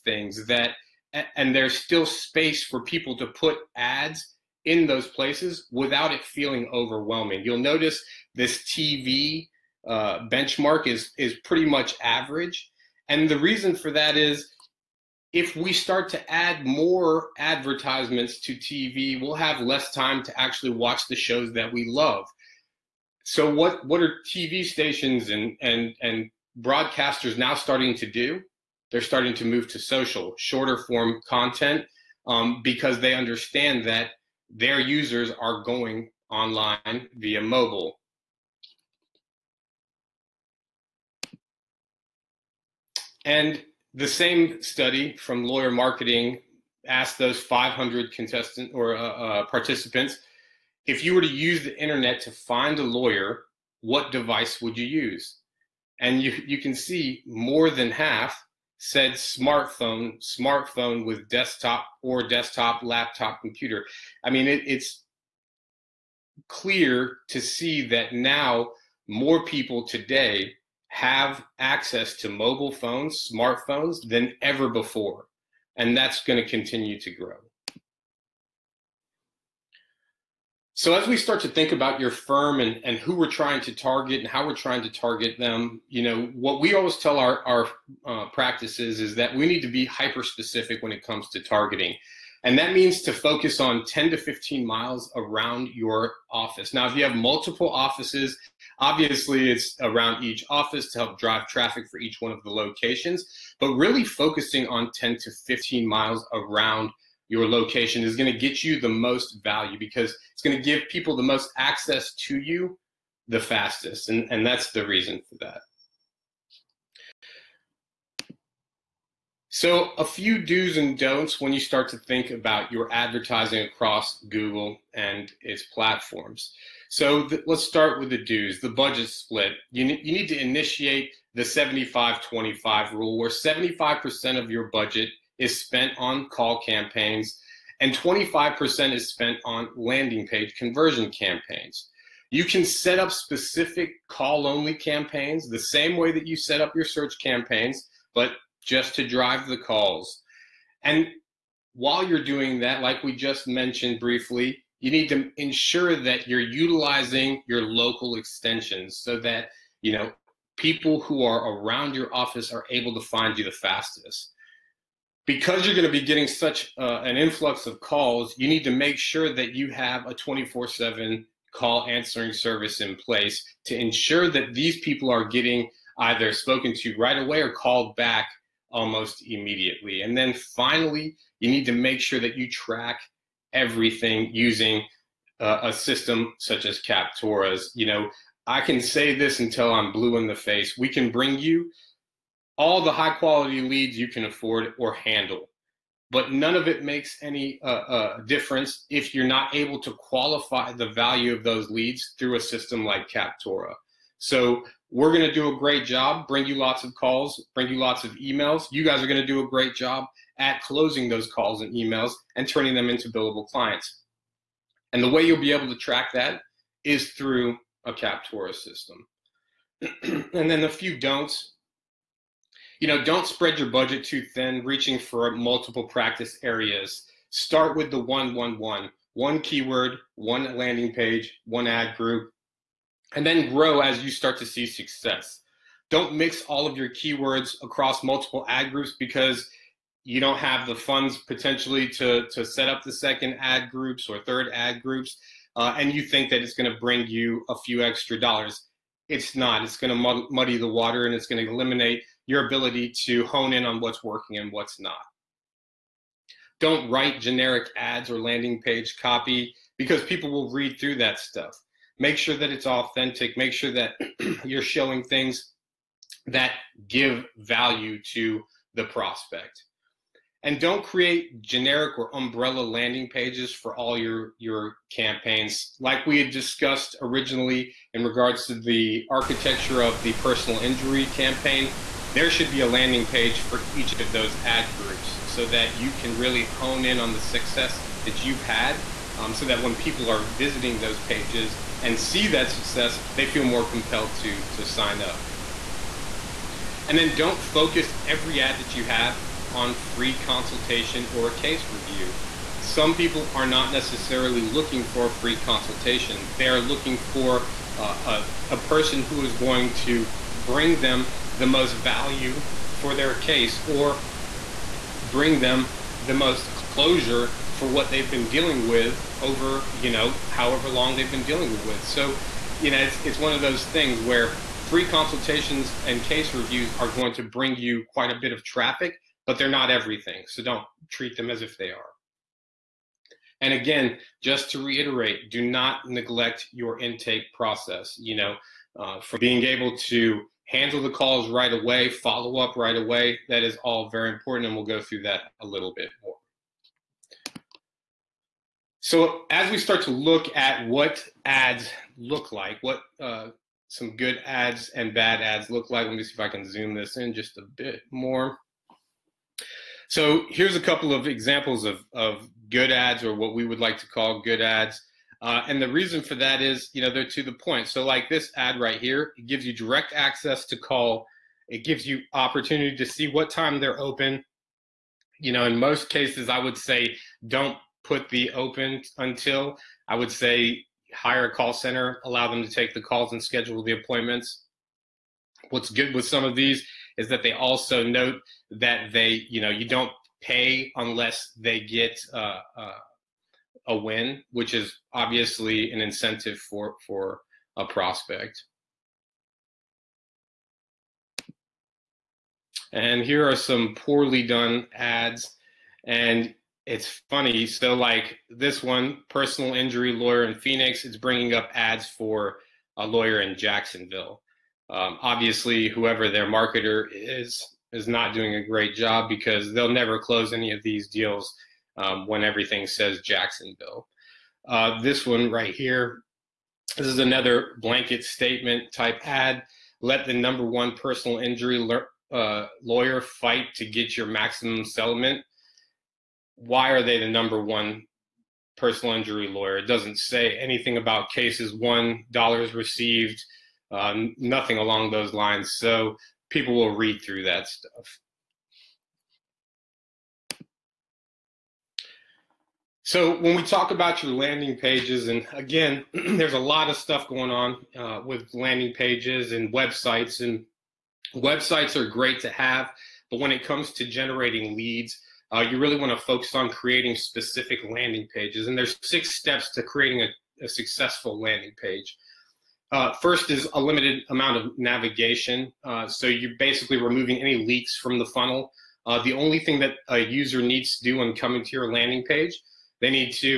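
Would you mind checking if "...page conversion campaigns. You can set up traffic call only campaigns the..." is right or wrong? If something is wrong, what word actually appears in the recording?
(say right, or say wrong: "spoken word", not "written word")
wrong: "specific", not "traffic".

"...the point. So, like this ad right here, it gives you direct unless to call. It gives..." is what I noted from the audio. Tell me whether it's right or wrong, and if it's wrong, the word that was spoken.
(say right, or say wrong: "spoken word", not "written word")
wrong: "access", not "unless".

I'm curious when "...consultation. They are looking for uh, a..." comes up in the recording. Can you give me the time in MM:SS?
05:05.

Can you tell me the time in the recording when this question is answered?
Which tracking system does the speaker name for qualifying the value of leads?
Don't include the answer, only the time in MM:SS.
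03:06.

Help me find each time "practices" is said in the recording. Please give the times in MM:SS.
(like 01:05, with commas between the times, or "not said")
01:28, 03:45.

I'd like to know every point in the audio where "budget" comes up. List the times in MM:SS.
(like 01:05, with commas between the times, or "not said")
02:08, 02:14, 03:43.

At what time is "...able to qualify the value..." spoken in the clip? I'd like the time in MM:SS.
03:19.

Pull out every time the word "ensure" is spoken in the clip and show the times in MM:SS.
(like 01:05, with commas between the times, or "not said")
02:35, 02:53.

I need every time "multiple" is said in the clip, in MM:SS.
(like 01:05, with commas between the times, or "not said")
01:37, 03:45, 03:58.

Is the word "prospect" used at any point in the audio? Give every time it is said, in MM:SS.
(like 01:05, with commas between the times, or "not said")
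04:28, 06:37.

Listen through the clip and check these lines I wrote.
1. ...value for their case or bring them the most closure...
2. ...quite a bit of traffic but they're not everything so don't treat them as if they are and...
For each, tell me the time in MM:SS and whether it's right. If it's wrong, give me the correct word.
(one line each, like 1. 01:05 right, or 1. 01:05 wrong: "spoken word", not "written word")
1. 05:11 right
2. 05:27 right.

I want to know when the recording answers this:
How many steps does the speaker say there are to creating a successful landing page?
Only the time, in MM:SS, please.
07:48.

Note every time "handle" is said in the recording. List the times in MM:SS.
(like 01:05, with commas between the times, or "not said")
03:14, 05:40.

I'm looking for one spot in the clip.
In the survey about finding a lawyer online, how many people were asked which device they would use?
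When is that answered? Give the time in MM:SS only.
00:47.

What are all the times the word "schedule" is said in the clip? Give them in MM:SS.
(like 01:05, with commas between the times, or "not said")
06:23.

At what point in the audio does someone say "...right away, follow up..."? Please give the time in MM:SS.
05:41.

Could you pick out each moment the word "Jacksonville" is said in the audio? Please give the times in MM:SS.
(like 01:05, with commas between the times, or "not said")
06:53, 07:03.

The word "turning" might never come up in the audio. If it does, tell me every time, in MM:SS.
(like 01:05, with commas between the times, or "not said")
03:32.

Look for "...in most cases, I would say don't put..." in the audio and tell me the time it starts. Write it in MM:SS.
06:15.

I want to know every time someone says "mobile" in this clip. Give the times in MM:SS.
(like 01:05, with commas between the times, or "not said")
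00:37, 01:12.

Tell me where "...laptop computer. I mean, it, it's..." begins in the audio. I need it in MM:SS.
01:02.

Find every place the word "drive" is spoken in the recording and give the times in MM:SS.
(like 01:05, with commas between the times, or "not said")
01:41, 02:29.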